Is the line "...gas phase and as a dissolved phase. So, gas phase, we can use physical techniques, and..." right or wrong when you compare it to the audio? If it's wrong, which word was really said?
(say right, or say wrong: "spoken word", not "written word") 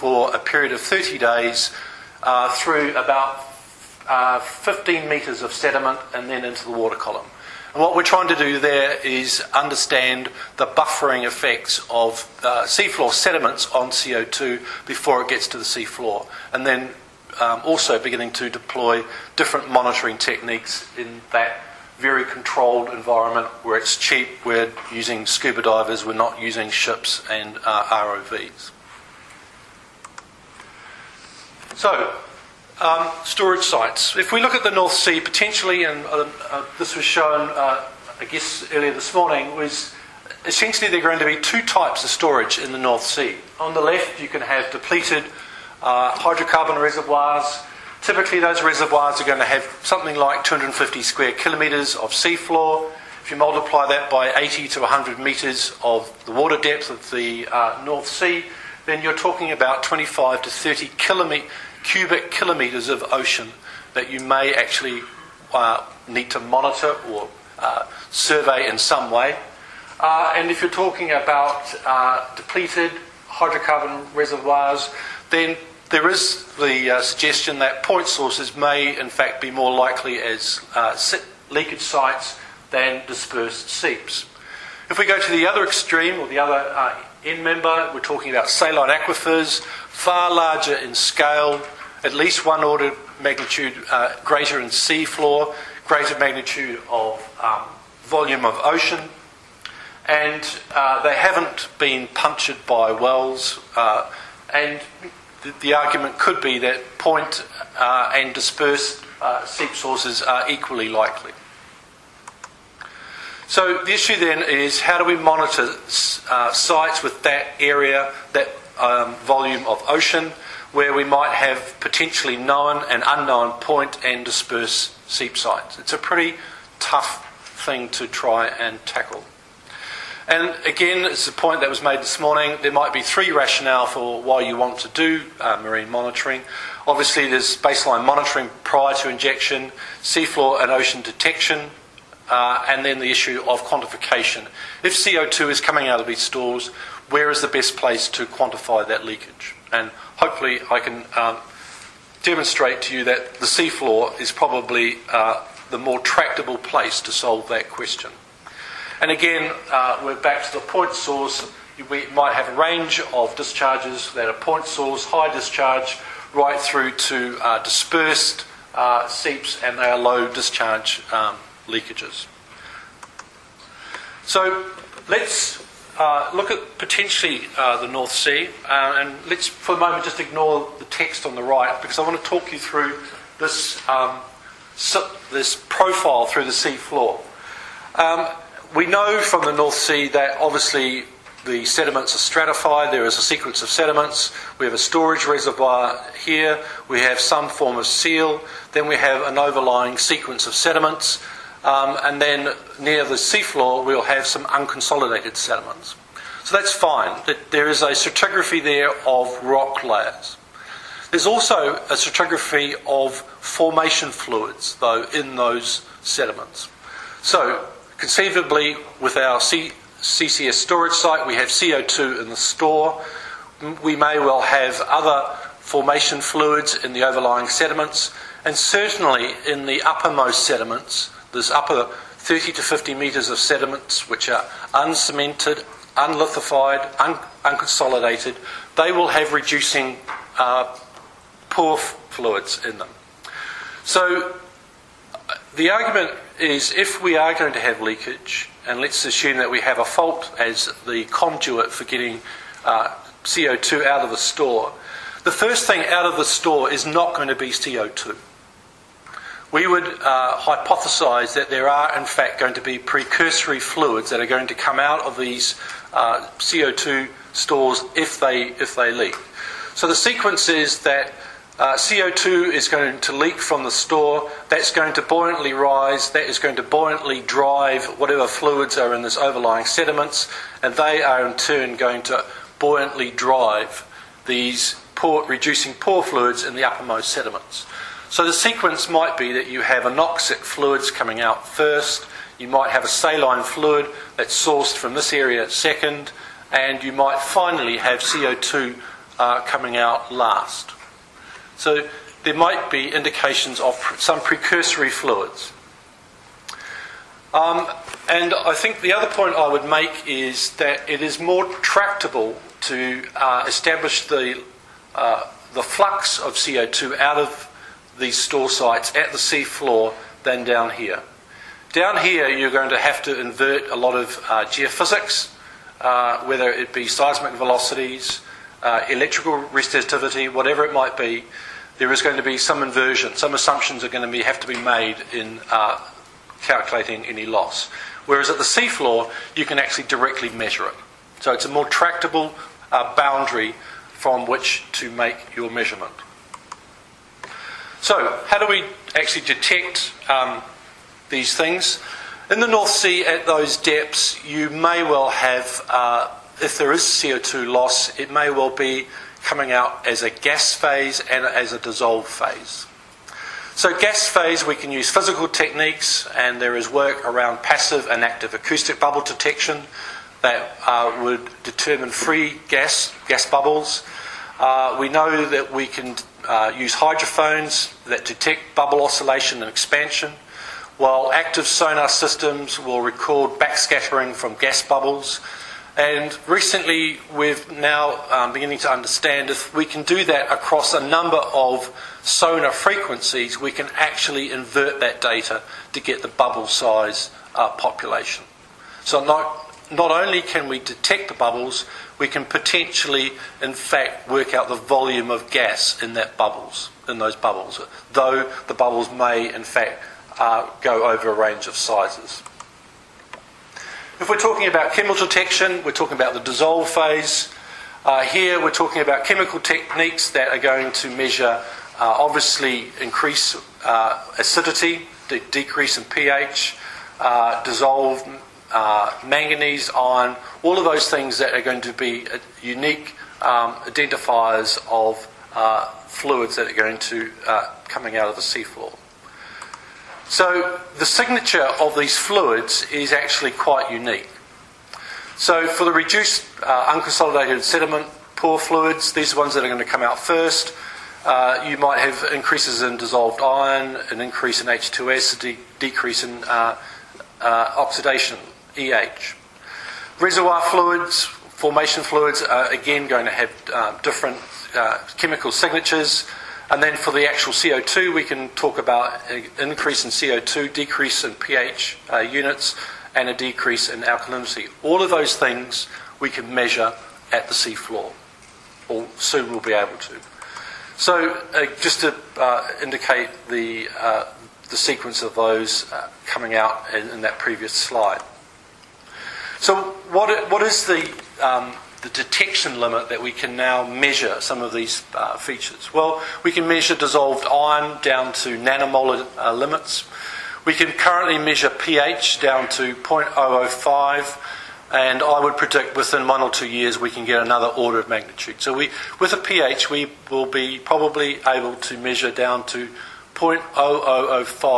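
right.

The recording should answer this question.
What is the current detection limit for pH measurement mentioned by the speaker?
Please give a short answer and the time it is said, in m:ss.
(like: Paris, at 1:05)
0.005, at 8:22.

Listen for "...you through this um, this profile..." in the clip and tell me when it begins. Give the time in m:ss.
3:02.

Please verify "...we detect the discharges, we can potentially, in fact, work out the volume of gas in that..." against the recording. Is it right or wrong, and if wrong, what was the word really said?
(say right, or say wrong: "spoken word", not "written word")
wrong: "bubbles", not "discharges".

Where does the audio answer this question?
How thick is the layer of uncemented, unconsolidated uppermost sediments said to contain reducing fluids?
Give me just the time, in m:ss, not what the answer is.
3:52.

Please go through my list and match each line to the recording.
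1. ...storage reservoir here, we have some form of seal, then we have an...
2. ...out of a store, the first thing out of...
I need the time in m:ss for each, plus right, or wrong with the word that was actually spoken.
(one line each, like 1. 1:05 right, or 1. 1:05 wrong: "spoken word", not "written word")
1. 3:14 right
2. 4:13 right.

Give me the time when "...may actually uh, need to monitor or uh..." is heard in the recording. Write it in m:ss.
1:04.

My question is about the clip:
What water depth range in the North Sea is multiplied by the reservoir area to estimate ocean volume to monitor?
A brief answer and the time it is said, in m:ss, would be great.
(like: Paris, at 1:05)
80 to 100 metres, at 0:54.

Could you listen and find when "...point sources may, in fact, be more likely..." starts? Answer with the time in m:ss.
1:17.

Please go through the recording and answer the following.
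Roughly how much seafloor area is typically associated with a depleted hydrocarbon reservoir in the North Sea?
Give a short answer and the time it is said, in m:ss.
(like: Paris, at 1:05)
250 square kilometres, at 0:50.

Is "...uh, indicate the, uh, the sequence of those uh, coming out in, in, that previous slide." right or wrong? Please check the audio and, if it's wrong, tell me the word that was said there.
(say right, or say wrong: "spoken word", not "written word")
right.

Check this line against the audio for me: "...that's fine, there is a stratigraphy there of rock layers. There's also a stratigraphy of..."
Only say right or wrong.
right.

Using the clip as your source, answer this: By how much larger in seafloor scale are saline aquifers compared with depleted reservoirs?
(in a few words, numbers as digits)
one order of magnitude.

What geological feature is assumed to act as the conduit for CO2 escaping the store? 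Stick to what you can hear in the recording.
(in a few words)
a fault.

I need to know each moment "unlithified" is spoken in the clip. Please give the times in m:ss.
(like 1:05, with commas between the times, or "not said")
3:55.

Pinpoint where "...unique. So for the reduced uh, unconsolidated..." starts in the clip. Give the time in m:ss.
7:23.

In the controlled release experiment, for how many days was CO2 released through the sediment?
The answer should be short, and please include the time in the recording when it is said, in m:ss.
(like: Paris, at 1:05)
30 days, at 0:00.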